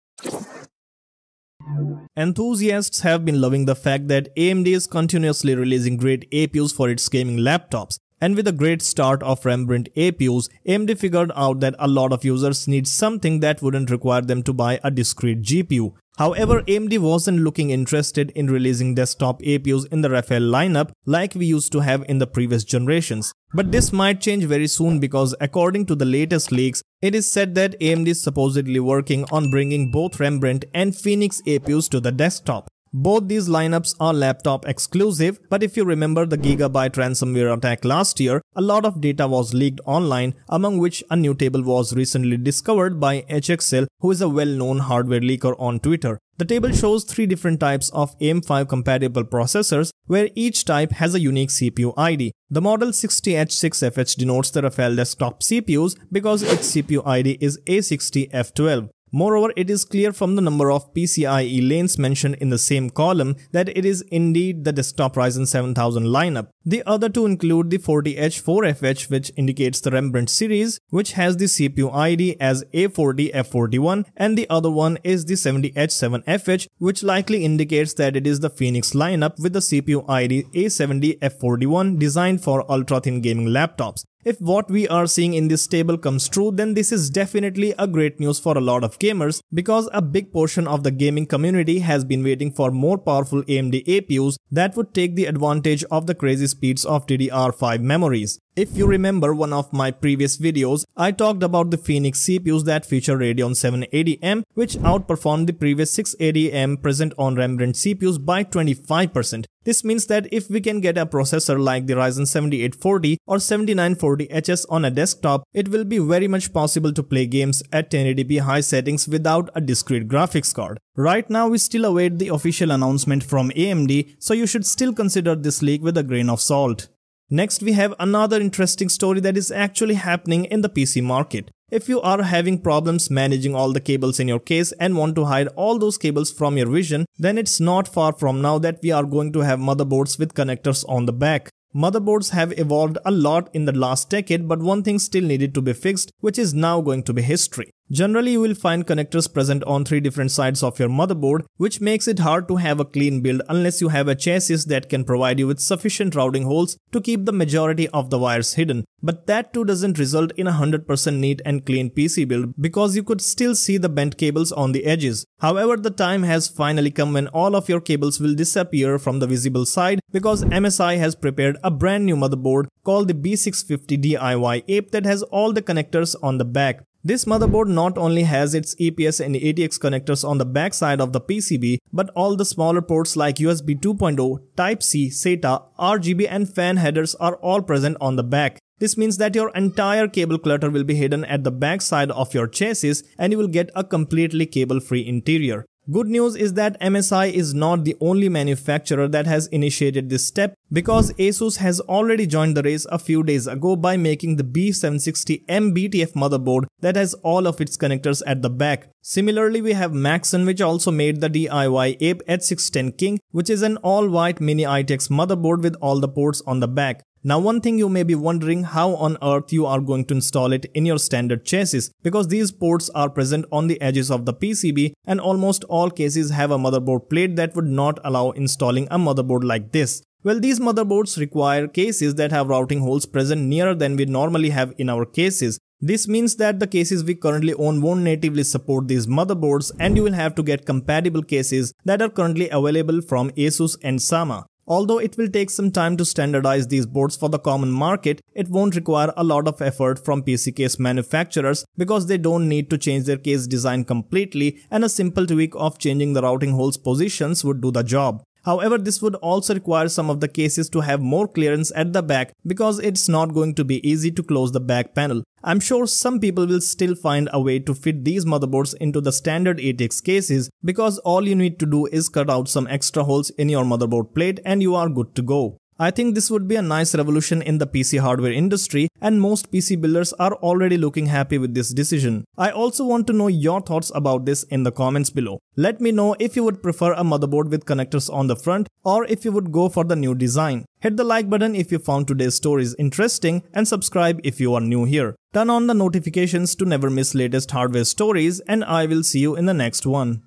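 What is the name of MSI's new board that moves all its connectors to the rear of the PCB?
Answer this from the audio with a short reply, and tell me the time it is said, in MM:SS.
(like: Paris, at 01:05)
B650 DIY Ape, at 02:53.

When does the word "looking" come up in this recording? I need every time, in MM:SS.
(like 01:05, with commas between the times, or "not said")
00:17, 04:40.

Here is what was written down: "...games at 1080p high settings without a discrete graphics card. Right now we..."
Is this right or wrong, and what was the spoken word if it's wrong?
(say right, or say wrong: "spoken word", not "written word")
right.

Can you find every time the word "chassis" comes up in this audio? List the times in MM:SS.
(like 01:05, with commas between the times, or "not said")
02:34, 03:12, 03:41.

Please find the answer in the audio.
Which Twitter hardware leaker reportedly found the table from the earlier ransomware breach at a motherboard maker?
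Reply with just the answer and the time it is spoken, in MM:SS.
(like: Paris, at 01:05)
HXL, at 00:43.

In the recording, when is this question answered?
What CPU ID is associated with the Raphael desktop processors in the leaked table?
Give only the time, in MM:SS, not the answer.
00:57.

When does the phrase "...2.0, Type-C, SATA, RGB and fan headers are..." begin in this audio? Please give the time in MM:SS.
03:03.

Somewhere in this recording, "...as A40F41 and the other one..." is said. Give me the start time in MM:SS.
01:12.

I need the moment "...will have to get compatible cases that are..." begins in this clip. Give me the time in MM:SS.
04:00.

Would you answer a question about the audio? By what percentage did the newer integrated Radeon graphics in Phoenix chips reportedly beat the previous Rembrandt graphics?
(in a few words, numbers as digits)
25%.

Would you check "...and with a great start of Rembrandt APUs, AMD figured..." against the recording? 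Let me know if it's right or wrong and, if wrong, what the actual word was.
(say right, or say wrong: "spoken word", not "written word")
right.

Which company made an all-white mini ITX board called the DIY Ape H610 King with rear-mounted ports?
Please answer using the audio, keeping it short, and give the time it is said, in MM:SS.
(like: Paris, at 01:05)
MaxSun, at 03:29.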